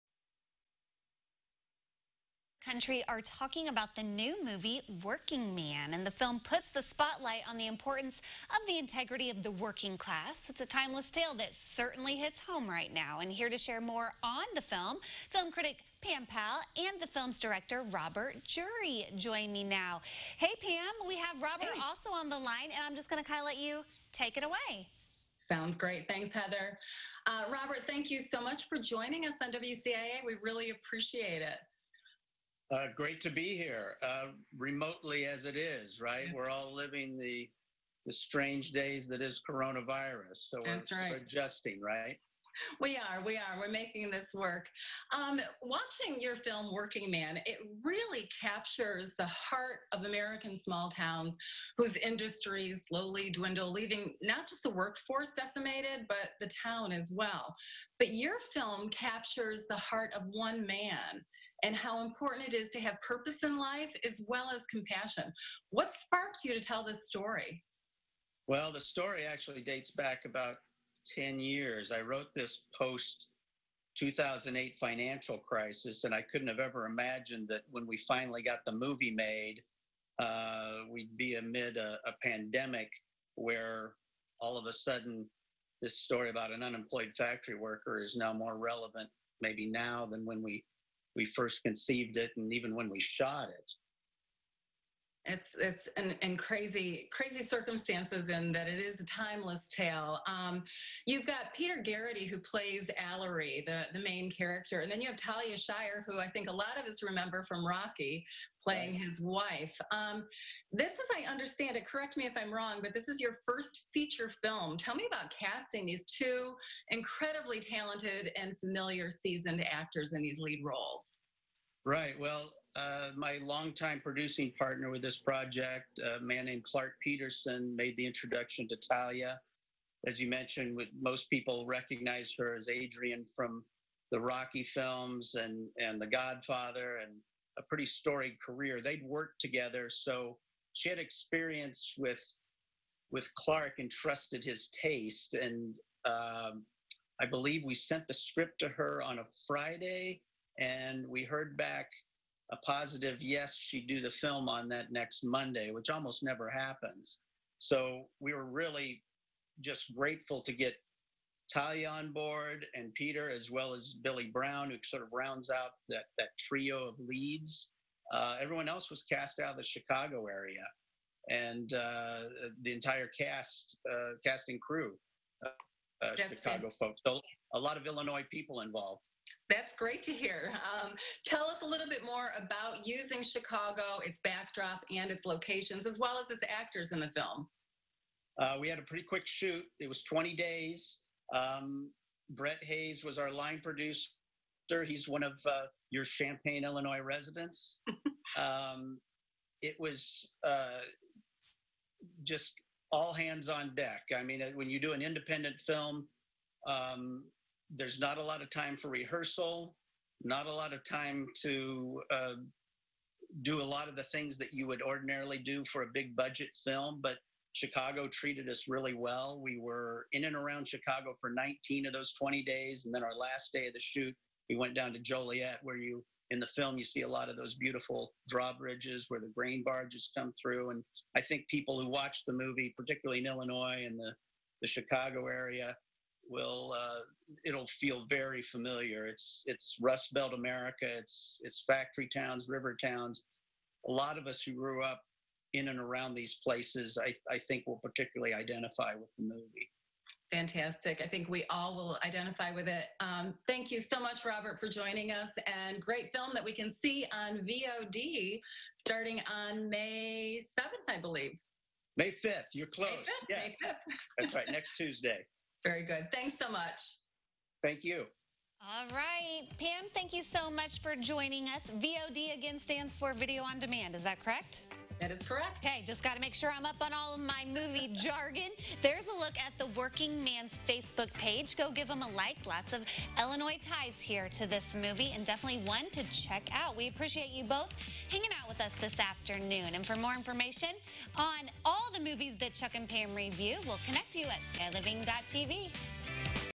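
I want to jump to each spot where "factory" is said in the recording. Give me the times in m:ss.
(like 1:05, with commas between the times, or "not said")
1:27, 4:01.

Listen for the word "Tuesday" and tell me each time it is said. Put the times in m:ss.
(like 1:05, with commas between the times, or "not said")
4:24.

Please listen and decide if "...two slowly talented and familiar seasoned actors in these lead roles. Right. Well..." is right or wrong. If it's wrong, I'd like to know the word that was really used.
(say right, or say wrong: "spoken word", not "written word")
wrong: "incredibly", not "slowly".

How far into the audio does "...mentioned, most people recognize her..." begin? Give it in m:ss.
2:10.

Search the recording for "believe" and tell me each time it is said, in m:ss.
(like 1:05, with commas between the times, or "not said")
2:27, 4:21.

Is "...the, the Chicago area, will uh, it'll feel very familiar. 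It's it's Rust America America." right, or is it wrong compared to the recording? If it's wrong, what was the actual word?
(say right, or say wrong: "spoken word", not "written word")
wrong: "Belt", not "America".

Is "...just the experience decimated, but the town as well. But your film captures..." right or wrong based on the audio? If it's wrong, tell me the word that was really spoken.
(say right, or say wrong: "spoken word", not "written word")
wrong: "workforce", not "experience".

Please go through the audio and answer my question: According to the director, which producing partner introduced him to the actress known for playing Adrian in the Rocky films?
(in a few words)
Clark Peterson.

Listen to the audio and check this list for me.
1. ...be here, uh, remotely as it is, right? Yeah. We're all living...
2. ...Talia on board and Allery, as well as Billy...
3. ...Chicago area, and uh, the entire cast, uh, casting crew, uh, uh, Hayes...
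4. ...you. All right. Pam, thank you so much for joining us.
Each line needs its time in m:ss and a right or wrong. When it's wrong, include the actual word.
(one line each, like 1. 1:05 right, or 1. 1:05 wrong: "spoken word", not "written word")
1. 0:33 right
2. 2:41 wrong: "Peter", not "Allery"
3. 2:49 wrong: "Chicago", not "Hayes"
4. 4:27 right.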